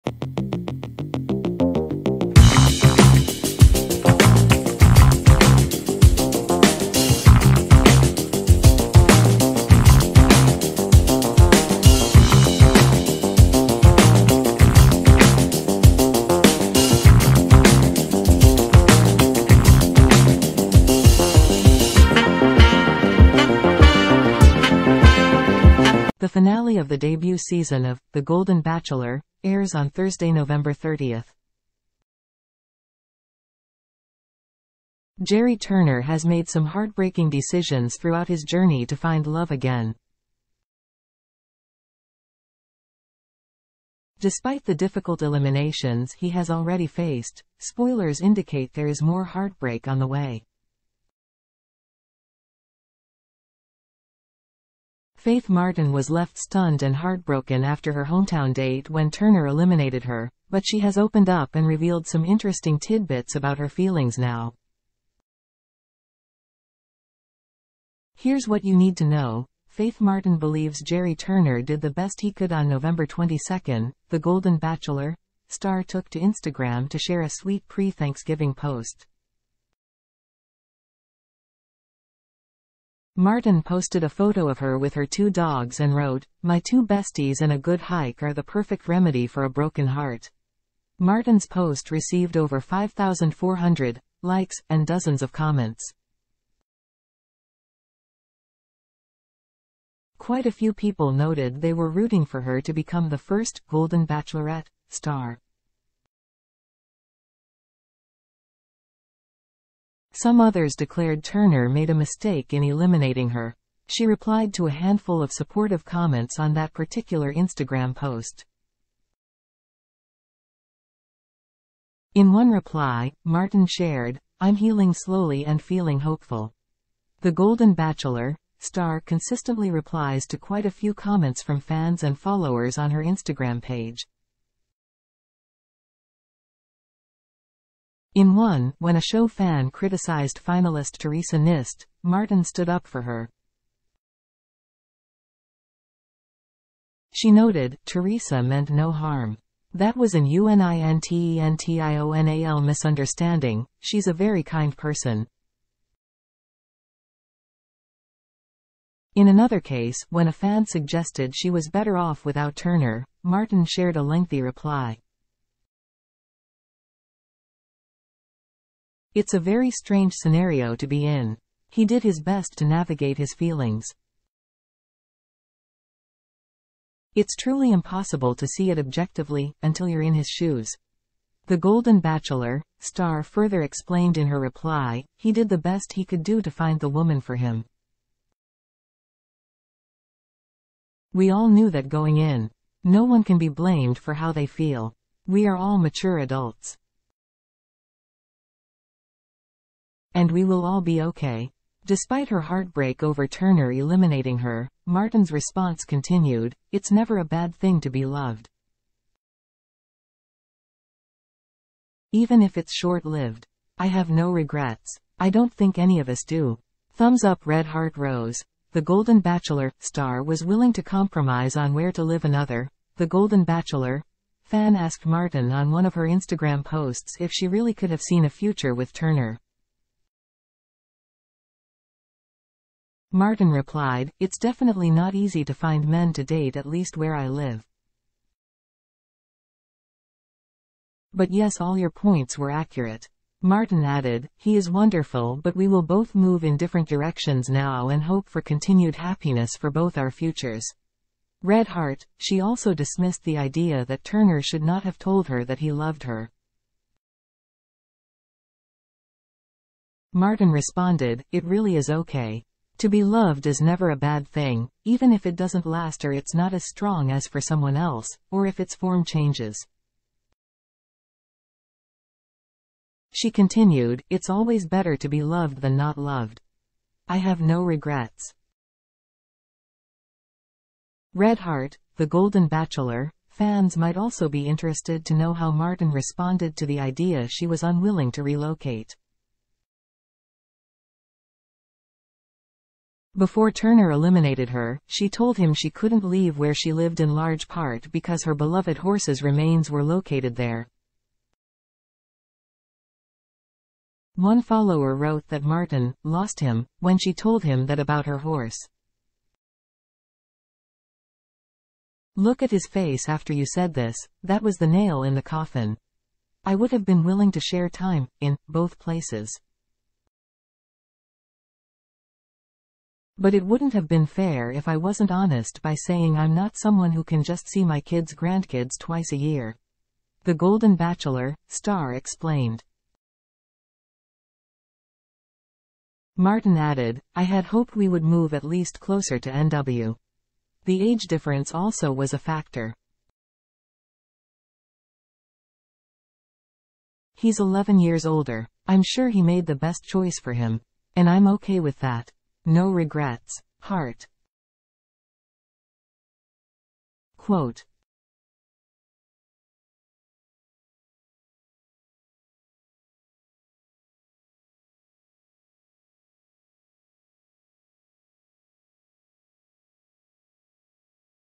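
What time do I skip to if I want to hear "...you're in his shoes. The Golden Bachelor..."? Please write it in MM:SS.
02:59.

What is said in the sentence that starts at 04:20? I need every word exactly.
Martin responded, it really is okay.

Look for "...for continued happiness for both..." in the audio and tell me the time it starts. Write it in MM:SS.
04:08.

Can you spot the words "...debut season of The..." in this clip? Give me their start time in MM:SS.
00:26.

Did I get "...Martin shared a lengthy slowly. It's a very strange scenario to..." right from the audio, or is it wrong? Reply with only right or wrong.
wrong.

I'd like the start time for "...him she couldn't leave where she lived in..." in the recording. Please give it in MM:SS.
04:55.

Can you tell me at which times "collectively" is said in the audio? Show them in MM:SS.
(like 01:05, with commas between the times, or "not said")
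not said.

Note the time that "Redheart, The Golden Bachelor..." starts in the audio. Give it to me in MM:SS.
04:41.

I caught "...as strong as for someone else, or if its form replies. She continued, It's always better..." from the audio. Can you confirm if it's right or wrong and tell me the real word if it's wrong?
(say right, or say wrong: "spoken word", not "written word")
wrong: "changes", not "replies".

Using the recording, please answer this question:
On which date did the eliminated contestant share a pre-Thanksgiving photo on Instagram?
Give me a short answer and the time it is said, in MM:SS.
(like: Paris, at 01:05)
November 22, at 01:12.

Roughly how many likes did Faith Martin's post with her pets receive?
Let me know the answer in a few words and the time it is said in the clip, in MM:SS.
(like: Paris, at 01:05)
5,400, at 01:32.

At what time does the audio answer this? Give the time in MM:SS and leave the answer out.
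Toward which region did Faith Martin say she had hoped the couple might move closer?
05:39.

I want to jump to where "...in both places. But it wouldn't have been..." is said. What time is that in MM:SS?
05:18.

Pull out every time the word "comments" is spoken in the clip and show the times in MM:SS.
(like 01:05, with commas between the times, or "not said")
01:35, 01:55, 02:10.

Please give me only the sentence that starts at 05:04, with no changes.
One follower wrote that Martin lost him when she told him that about her horse.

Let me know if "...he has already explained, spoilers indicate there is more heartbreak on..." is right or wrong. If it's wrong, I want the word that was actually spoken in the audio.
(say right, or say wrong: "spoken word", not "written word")
wrong: "faced", not "explained".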